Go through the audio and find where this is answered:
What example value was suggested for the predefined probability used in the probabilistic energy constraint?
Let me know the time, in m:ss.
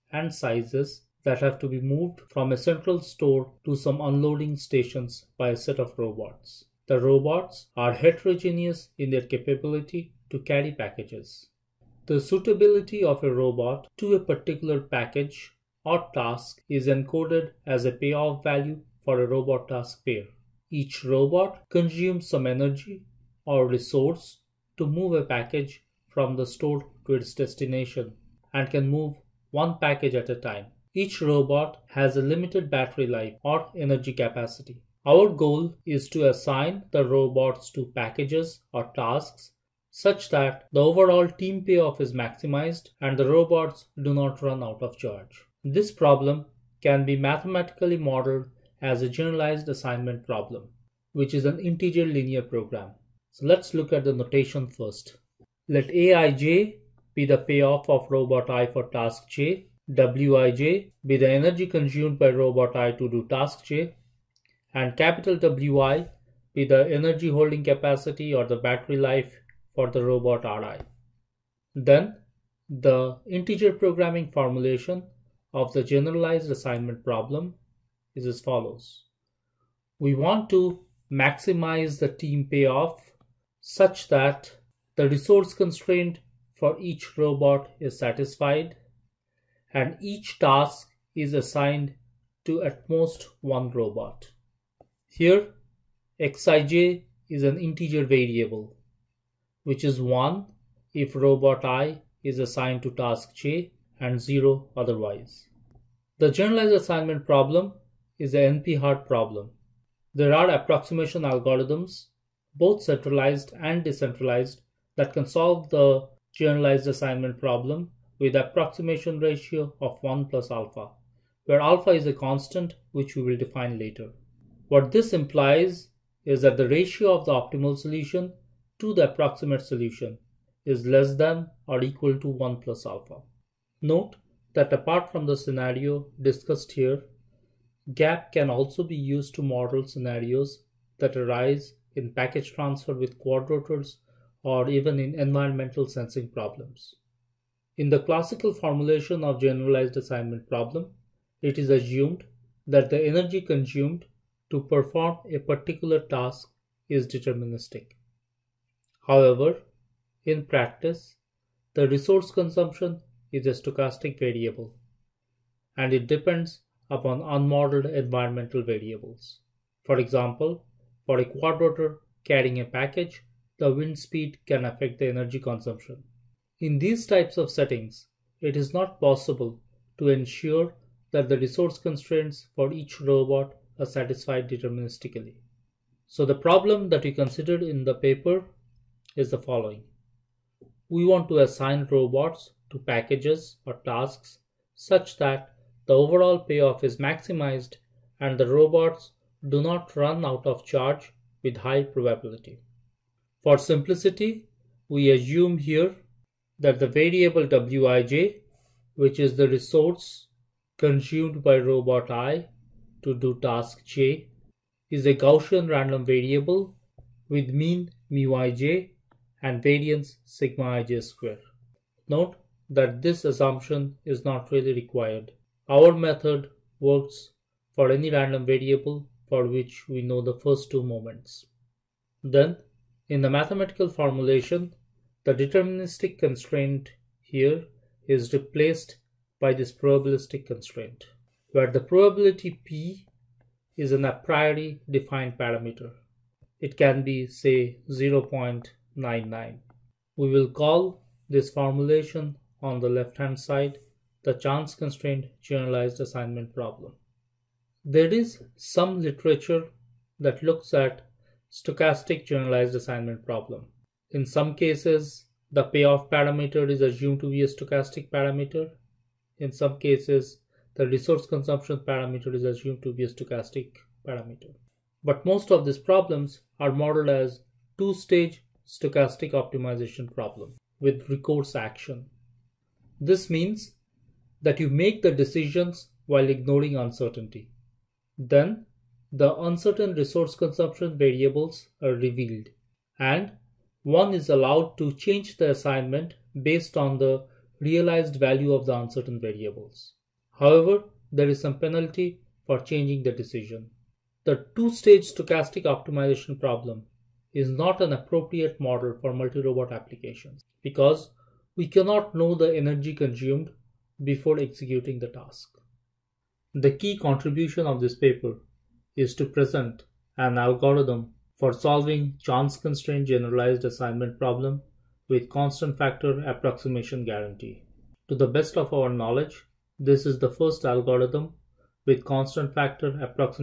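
4:07.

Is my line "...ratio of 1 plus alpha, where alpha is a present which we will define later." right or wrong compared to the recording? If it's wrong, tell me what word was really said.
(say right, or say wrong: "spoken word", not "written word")
wrong: "constant", not "present".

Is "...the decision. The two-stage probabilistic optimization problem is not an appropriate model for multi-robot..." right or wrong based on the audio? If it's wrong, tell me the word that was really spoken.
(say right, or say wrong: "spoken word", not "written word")
wrong: "stochastic", not "probabilistic".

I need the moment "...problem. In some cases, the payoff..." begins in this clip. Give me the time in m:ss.
4:23.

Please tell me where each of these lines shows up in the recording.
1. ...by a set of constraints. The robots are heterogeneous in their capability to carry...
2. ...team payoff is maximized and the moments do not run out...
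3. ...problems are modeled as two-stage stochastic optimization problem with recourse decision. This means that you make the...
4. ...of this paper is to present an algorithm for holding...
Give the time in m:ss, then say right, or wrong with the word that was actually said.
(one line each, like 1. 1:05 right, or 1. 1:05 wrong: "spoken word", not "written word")
1. 0:05 wrong: "robots", not "constraints"
2. 0:41 wrong: "robots", not "moments"
3. 4:35 wrong: "action", not "decision"
4. 5:17 wrong: "solving", not "holding".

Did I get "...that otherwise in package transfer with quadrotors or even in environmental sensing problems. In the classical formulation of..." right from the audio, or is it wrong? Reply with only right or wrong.
wrong.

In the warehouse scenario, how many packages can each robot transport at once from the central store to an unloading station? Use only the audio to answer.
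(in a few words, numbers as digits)
1.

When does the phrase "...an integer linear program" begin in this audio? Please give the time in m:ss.
0:51.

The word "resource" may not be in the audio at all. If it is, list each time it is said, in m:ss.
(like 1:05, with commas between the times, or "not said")
0:23, 1:25, 2:41, 3:01, 3:29, 4:30, 4:49.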